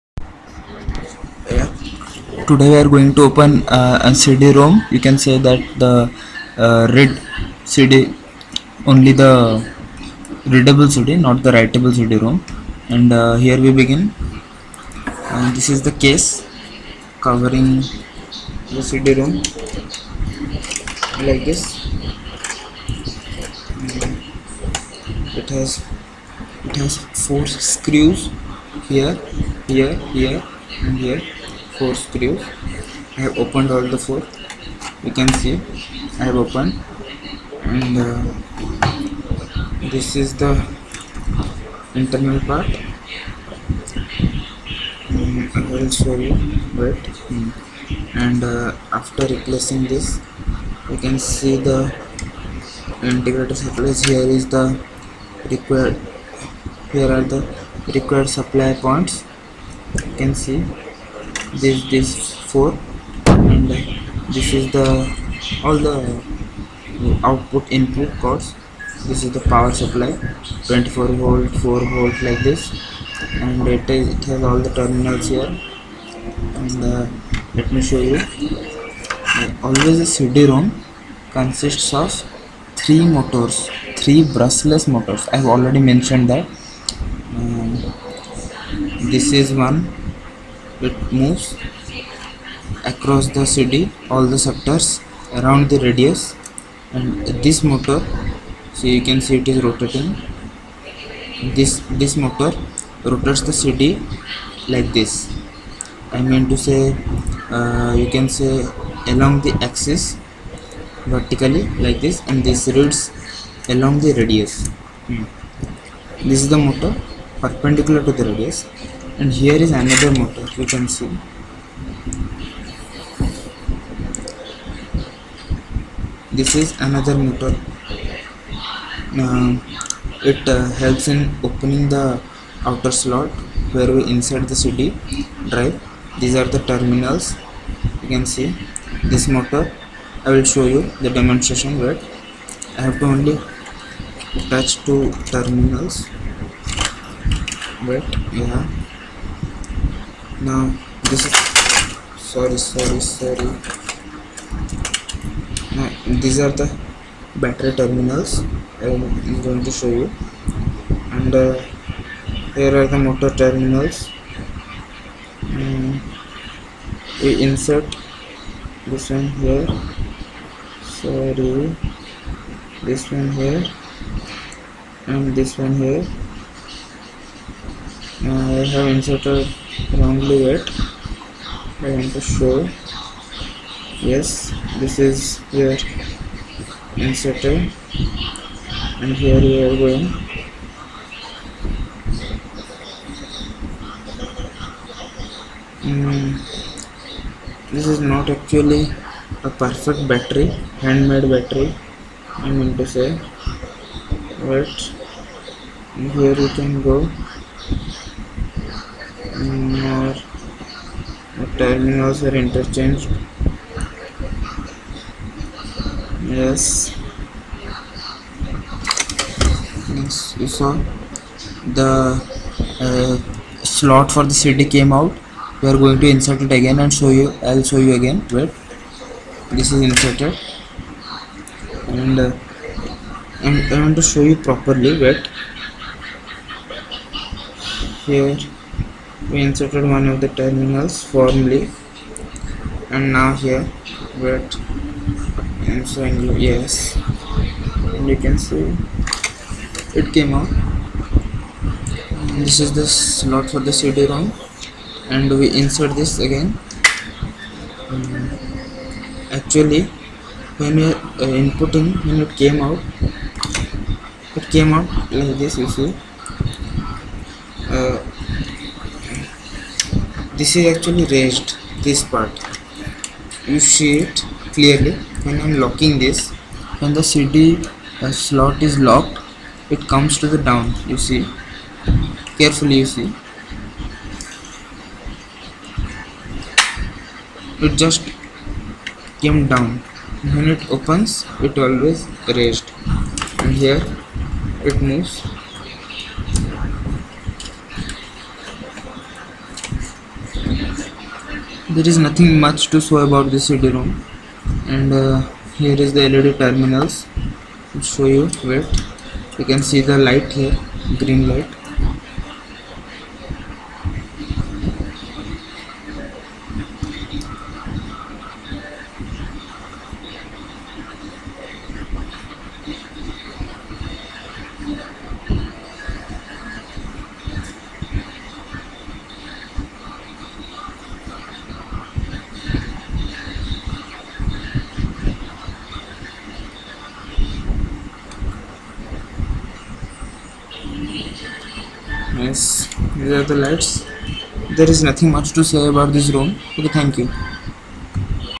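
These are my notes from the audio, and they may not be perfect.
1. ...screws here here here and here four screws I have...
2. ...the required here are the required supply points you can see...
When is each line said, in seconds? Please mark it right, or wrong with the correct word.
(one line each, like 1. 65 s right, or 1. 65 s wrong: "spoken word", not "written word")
1. 27 s right
2. 54 s right.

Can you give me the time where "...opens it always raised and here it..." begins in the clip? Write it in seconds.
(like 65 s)
290 s.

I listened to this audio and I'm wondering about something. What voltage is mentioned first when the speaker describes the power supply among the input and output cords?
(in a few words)
24 volt.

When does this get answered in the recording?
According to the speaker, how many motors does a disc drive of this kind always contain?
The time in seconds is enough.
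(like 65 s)
82 s.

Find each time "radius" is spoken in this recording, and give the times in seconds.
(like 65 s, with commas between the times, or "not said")
95 s, 114 s, 118 s.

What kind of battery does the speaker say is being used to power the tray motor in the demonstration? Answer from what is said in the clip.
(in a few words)
handmade battery.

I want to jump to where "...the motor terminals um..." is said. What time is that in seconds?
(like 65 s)
162 s.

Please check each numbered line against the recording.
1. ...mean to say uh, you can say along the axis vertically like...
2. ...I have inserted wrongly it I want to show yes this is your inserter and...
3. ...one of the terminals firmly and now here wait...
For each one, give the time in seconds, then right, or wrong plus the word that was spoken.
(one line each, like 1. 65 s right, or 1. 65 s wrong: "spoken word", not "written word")
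1. 106 s right
2. 178 s right
3. 239 s right.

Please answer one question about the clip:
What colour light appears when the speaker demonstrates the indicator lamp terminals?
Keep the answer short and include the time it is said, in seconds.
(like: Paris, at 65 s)
green, at 310 s.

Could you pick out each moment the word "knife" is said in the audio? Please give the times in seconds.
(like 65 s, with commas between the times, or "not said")
not said.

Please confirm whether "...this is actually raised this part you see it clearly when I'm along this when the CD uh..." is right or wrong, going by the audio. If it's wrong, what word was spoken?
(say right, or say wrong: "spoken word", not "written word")
wrong: "locking", not "along".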